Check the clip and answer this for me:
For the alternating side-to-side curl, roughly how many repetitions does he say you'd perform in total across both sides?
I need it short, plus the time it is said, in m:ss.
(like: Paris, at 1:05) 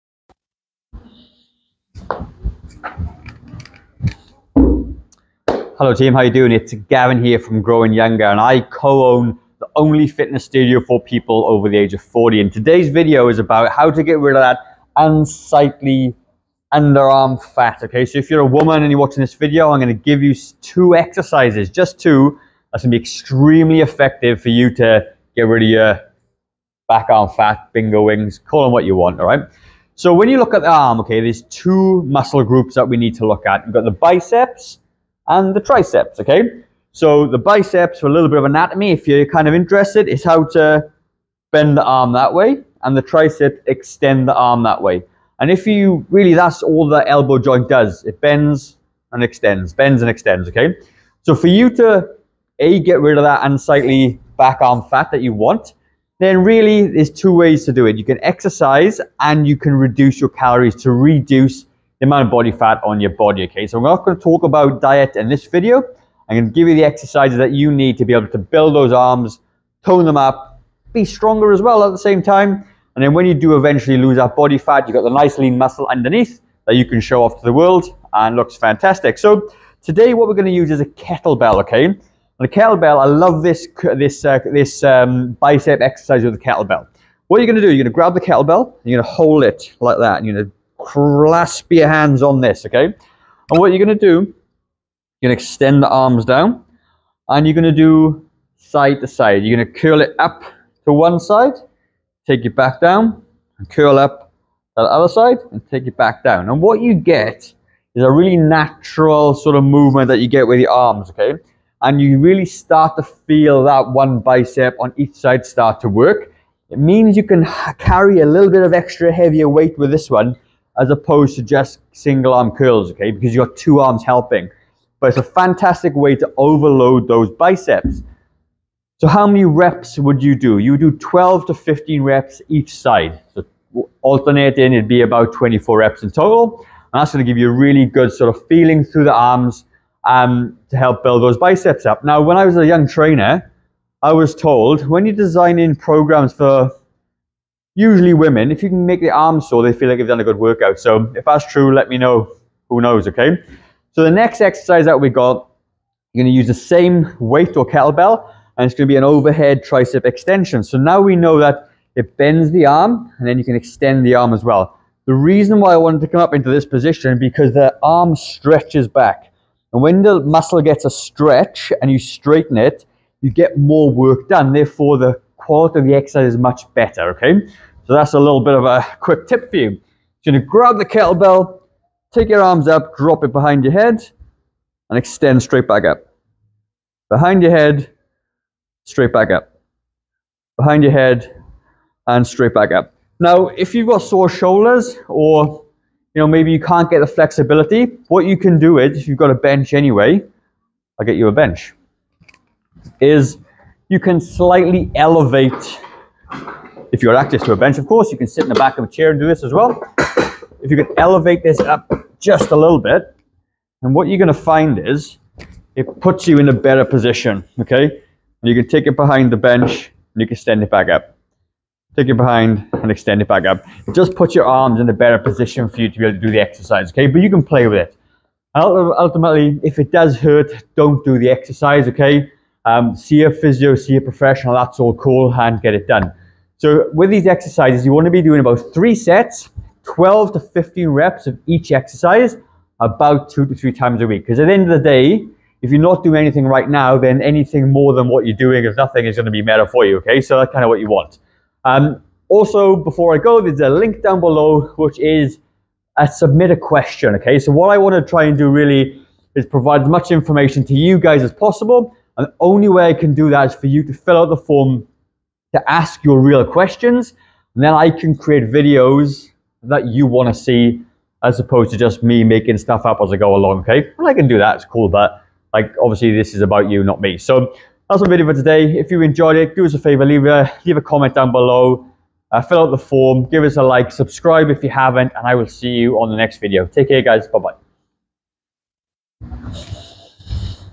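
24, at 2:15.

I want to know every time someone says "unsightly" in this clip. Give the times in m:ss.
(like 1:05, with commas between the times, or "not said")
0:14, 0:53.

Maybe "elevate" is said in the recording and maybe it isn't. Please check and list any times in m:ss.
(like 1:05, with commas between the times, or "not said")
3:24, 3:30.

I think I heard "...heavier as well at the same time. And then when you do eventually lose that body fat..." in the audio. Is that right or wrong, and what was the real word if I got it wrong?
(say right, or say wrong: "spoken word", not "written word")
wrong: "stronger", not "heavier".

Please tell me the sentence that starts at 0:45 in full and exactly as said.
And if you, really, that's all the elbow joint does.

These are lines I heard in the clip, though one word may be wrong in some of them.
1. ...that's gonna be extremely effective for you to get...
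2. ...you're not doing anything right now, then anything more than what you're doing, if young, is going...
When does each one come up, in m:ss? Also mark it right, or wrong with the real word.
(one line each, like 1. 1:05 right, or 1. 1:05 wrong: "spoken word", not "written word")
1. 0:22 right
2. 4:05 wrong: "nothing", not "young".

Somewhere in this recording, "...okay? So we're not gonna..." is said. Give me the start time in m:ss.
1:03.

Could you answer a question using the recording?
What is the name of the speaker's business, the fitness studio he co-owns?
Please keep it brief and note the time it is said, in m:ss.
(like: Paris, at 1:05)
Growing Younger, at 0:07.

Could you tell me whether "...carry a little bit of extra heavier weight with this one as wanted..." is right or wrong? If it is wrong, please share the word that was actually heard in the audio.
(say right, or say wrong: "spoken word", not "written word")
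wrong: "opposed", not "wanted".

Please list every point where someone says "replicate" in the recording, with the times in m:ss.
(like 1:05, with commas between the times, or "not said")
not said.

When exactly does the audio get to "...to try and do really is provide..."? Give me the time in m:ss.
4:17.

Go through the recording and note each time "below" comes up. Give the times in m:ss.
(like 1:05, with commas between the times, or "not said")
4:14, 4:41.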